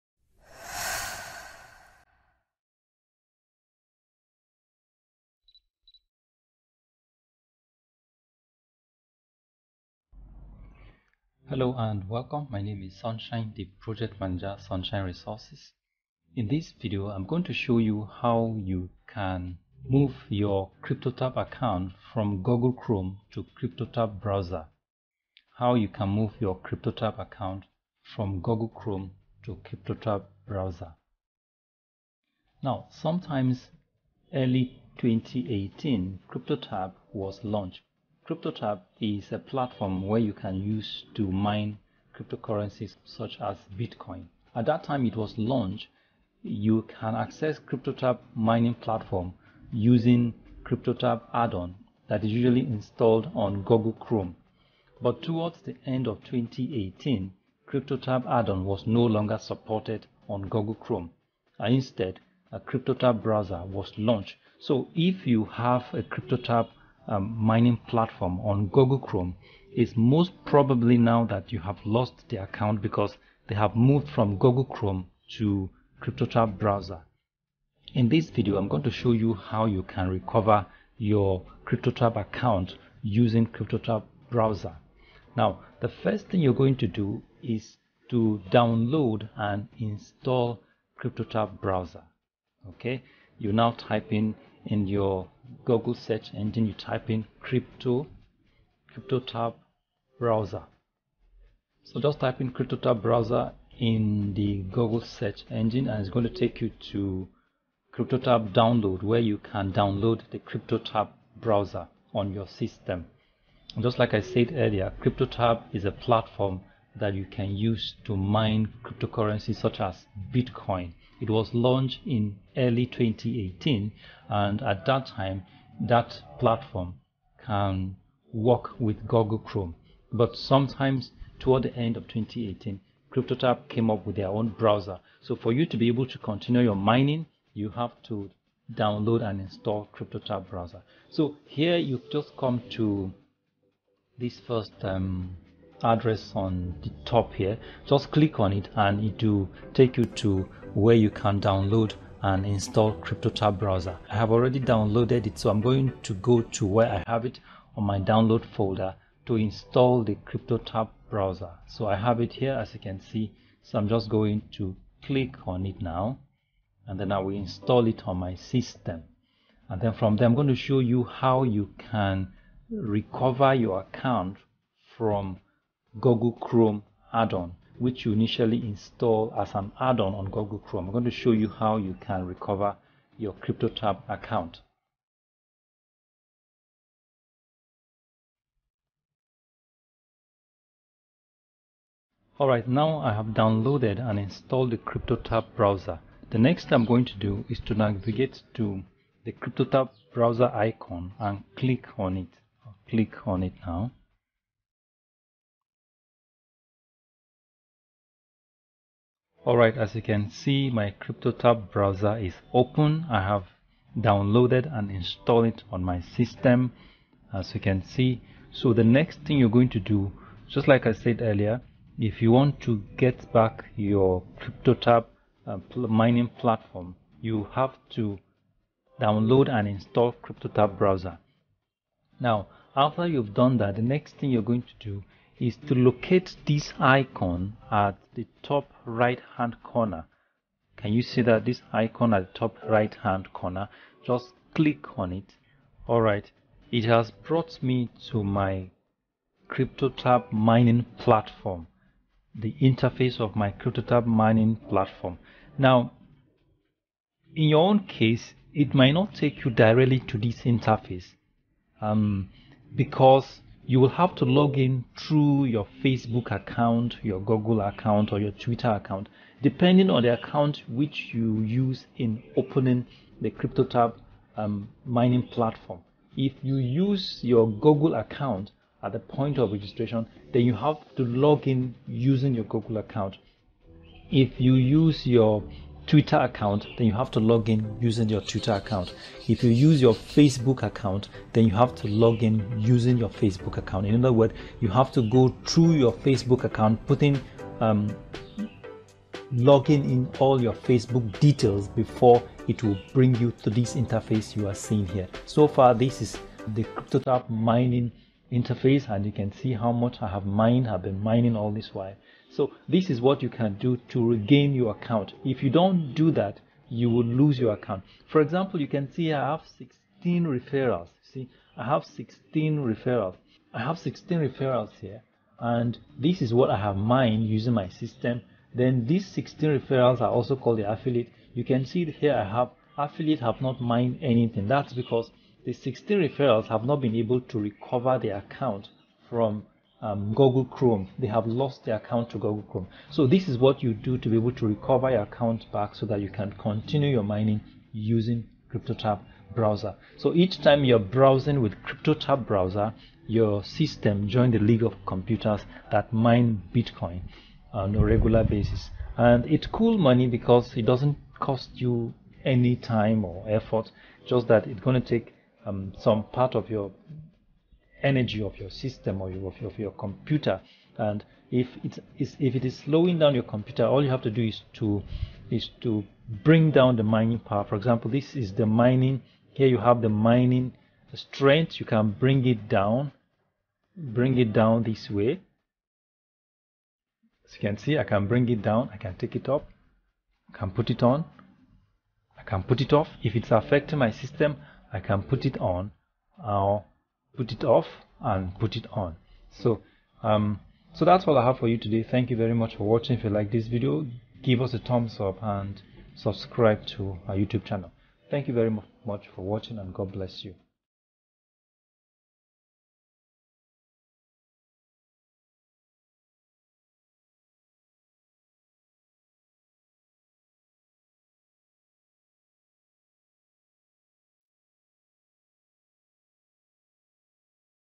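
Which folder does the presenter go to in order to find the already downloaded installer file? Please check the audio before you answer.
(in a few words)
download folder.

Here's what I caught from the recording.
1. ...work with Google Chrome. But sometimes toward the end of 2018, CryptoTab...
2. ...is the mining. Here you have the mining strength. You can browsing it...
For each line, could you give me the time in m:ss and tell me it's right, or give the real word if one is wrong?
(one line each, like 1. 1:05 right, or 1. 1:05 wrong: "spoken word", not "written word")
1. 2:08 right
2. 6:18 wrong: "bring", not "browsing".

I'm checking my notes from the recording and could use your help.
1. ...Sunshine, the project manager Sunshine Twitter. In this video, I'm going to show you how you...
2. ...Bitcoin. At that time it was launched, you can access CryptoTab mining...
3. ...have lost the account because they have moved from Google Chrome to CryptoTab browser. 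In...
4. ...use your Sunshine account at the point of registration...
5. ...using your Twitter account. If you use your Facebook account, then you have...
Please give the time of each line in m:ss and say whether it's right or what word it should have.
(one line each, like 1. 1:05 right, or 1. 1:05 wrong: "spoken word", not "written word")
1. 0:12 wrong: "Resources", not "Twitter"
2. 0:43 right
3. 1:11 right
4. 4:36 wrong: "Google", not "Sunshine"
5. 4:47 right.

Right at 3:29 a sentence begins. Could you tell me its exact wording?
Alright, as you can see, my CryptoTab browser is open.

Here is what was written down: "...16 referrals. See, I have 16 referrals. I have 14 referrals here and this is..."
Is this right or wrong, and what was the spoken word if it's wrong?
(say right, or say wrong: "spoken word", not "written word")
wrong: "16", not "14".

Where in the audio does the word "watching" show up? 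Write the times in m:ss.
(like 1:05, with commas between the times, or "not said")
6:42, 6:49.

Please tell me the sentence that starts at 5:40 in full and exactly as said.
They have lost their account to Google Chrome.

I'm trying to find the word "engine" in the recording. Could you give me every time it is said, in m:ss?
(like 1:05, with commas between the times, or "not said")
1:36, 1:45.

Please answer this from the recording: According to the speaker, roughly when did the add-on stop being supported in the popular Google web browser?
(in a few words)
end of 2018.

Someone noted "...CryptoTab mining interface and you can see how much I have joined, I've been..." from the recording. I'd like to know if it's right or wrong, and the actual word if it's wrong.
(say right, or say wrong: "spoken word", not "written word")
wrong: "mined", not "joined".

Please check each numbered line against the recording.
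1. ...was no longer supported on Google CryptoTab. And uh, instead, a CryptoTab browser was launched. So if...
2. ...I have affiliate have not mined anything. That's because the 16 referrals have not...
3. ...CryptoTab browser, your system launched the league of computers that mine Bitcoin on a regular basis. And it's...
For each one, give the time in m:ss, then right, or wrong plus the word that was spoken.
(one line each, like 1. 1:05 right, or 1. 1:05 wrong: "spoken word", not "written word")
1. 0:58 wrong: "Chrome", not "CryptoTab"
2. 5:32 right
3. 5:51 wrong: "joined", not "launched".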